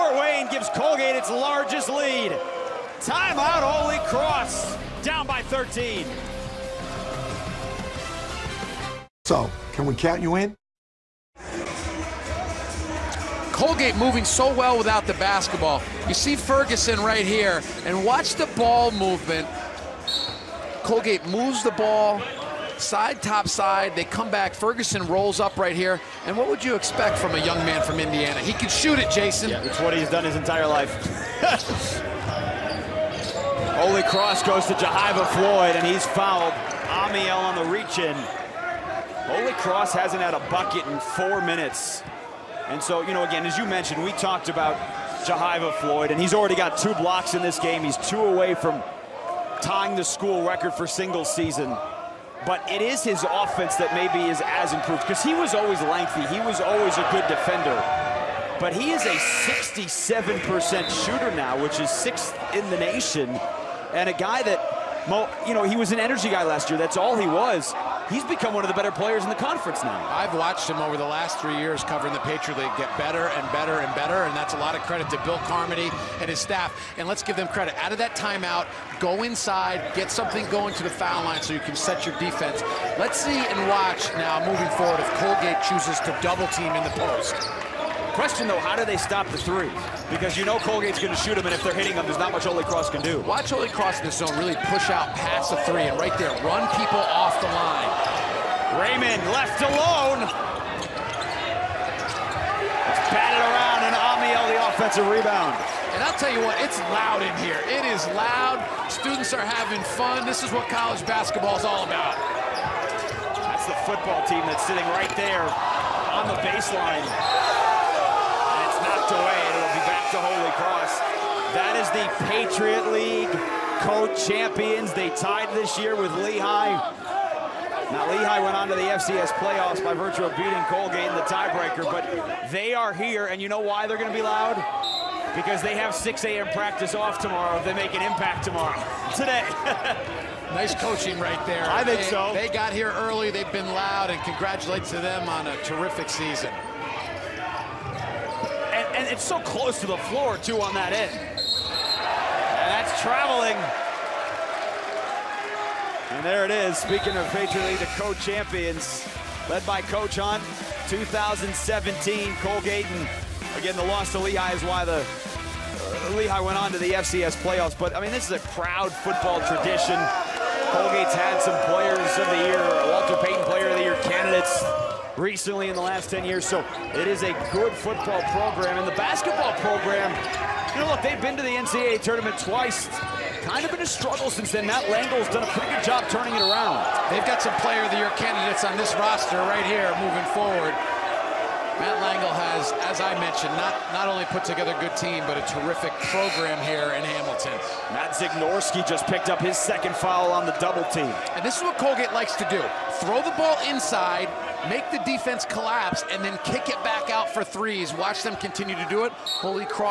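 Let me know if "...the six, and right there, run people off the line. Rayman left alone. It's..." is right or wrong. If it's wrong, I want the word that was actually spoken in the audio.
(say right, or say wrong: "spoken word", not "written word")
wrong: "three", not "six".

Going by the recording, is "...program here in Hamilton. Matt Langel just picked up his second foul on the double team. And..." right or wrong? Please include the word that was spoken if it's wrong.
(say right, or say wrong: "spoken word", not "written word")
wrong: "Zignorski", not "Langel".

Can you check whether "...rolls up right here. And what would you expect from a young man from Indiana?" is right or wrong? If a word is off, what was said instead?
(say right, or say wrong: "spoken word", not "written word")
right.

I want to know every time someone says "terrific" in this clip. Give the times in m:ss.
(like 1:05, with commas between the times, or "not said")
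2:25, 3:15.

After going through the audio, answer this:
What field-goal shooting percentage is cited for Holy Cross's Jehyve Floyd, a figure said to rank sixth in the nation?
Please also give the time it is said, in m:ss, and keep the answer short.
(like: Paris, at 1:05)
67%, at 0:59.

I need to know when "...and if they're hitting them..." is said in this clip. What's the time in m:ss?
1:31.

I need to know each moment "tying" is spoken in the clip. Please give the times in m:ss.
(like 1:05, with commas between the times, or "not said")
0:49.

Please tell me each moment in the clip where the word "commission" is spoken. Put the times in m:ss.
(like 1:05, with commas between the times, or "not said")
not said.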